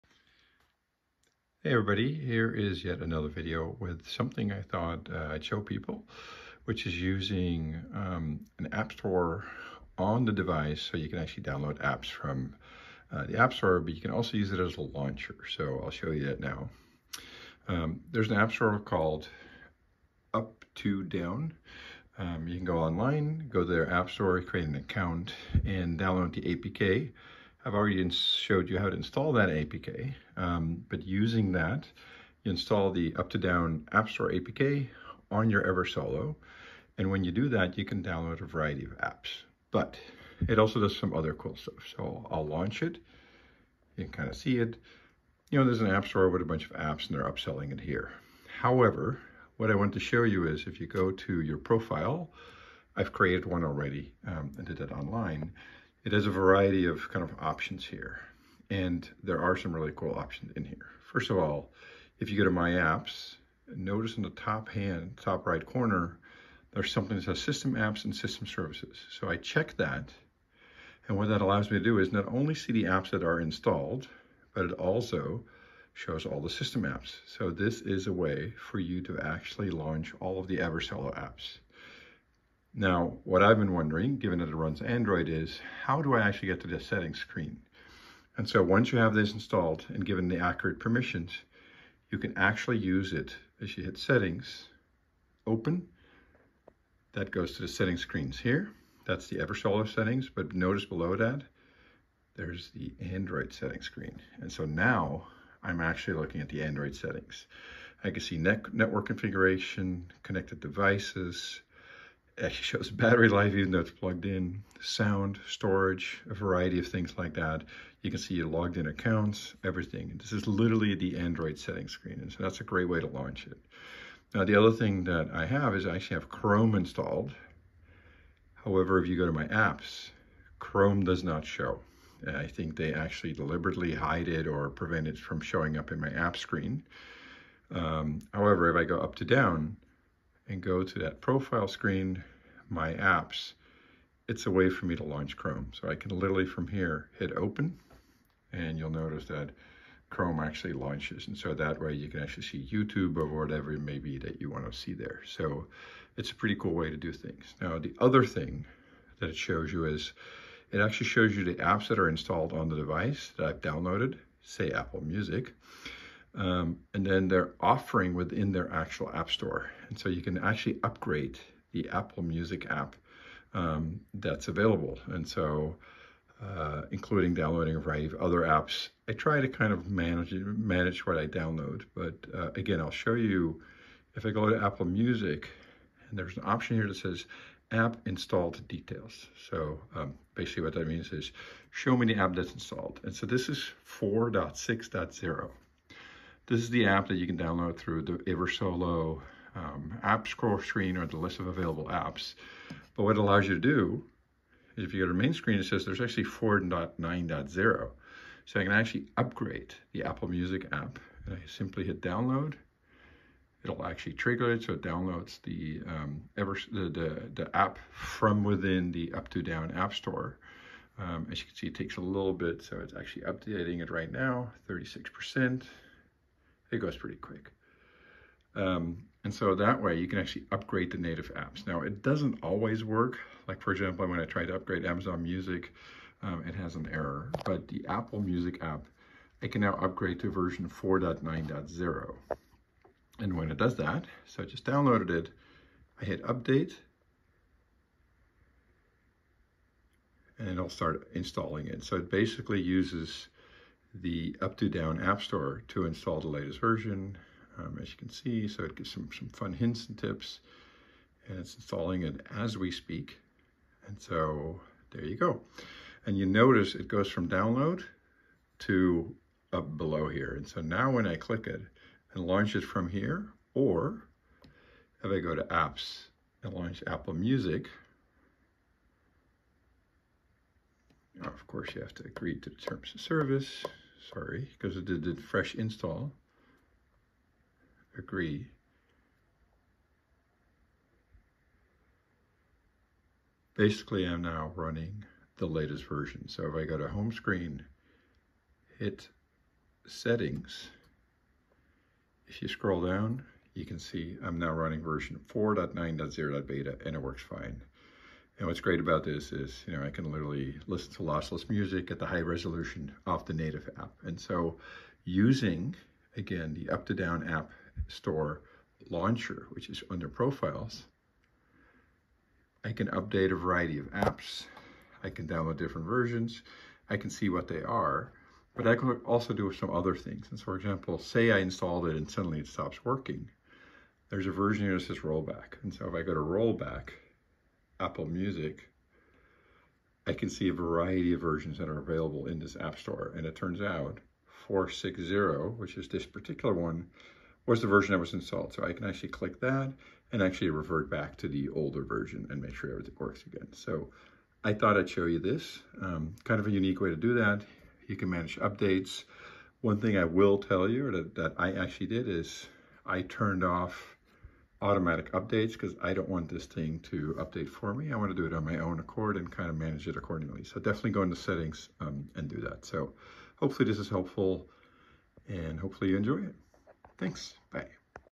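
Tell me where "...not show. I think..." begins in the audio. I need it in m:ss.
2:11.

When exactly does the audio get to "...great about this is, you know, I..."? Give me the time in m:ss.
5:08.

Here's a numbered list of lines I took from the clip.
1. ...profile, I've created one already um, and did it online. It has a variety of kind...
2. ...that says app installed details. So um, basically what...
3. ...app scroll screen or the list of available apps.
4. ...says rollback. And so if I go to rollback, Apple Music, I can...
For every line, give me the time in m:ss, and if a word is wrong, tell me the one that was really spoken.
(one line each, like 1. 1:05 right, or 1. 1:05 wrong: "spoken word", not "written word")
1. 0:51 right
2. 3:06 right
3. 3:20 right
4. 5:34 right.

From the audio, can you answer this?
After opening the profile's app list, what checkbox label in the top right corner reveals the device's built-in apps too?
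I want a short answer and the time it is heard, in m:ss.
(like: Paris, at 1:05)
System Apps and System Services, at 1:07.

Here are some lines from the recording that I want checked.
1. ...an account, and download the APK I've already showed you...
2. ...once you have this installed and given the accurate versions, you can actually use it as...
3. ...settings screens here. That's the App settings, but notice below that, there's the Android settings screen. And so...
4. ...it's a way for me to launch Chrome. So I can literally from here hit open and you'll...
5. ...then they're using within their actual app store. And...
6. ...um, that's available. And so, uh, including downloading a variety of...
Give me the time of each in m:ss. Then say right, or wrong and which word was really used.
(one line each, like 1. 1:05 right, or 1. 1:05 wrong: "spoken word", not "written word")
1. 0:24 right
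2. 1:28 wrong: "permissions", not "versions"
3. 1:37 wrong: "Eversolo", not "App"
4. 2:24 right
5. 2:47 wrong: "offering", not "using"
6. 2:53 right.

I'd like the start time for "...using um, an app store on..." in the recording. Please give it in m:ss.
0:06.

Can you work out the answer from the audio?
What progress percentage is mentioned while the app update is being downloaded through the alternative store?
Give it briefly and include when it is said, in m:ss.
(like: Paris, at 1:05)
36%, at 3:44.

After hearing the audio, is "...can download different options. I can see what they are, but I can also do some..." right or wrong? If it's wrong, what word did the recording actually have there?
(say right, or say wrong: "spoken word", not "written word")
wrong: "versions", not "options".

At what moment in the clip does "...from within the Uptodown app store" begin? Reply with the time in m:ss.
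3:37.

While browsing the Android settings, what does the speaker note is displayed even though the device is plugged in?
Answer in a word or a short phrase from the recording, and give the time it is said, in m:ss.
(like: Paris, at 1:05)
Battery life, at 1:52.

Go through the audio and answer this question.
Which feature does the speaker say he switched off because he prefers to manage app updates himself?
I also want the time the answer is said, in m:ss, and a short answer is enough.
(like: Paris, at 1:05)
Automatic updates, at 6:04.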